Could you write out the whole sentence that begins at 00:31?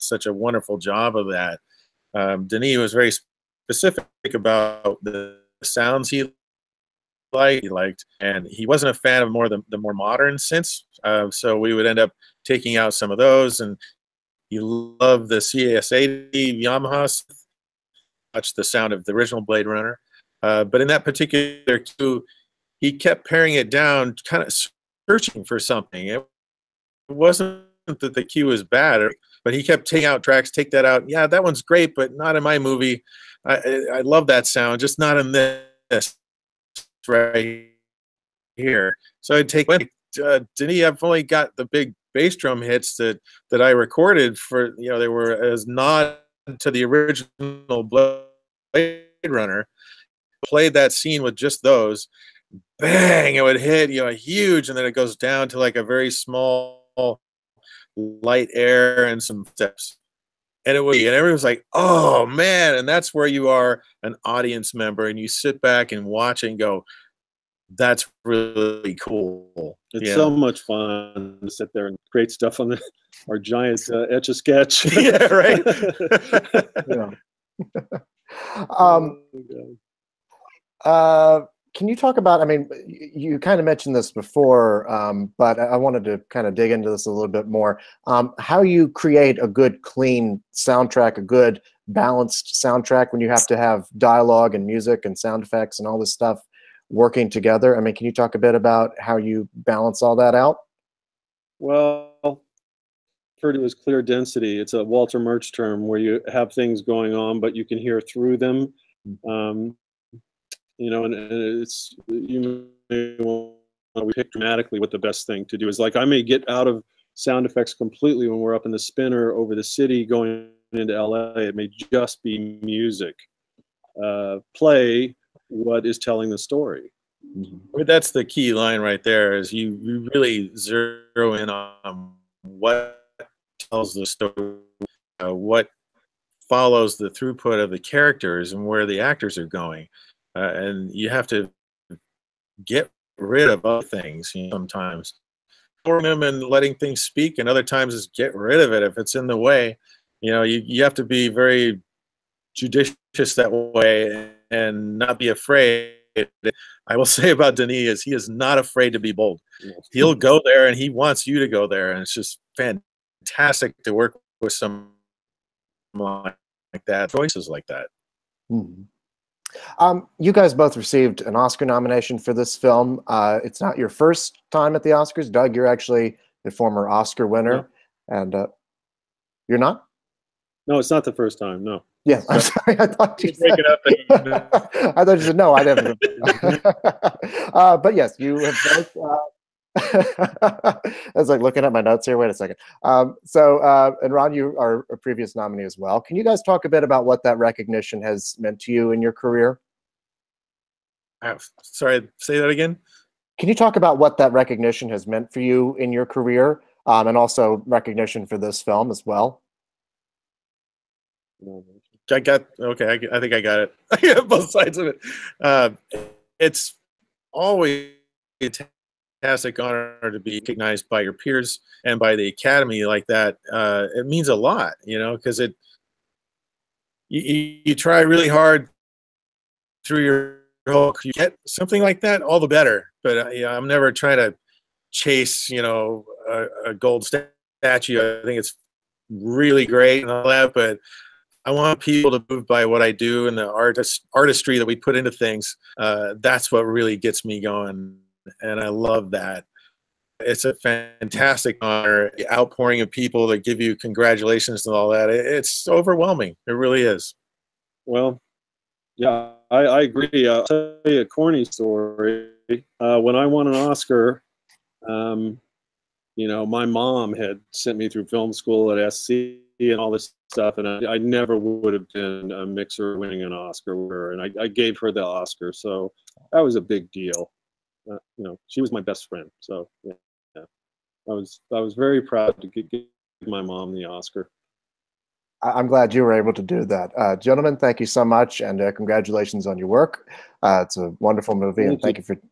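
Yeah, that one's great, but not in my movie.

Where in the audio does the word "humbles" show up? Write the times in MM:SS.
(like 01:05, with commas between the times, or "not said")
not said.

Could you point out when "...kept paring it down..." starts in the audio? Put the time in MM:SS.
00:22.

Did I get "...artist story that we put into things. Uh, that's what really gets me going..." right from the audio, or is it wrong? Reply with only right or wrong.
wrong.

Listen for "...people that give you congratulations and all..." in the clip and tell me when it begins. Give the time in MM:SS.
04:12.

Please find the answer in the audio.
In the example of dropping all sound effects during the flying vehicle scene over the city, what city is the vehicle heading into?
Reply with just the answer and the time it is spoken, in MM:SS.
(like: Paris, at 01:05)
LA, at 02:00.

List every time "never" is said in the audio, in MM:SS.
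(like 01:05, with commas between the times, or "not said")
03:05, 03:53, 04:30.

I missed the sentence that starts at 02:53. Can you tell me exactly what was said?
Uh, it's not your first time at the Oscars.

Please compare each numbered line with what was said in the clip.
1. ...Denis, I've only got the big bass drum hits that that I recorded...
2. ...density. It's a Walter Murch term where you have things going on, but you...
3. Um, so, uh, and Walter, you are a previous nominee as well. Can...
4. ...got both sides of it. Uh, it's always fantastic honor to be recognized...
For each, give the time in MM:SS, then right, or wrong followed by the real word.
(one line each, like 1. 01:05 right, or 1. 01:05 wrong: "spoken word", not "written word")
1. 00:40 right
2. 01:44 right
3. 03:12 wrong: "Ron", not "Walter"
4. 03:33 right.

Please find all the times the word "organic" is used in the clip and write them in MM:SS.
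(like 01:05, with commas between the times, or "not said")
not said.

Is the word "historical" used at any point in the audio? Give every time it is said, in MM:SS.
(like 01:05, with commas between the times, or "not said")
not said.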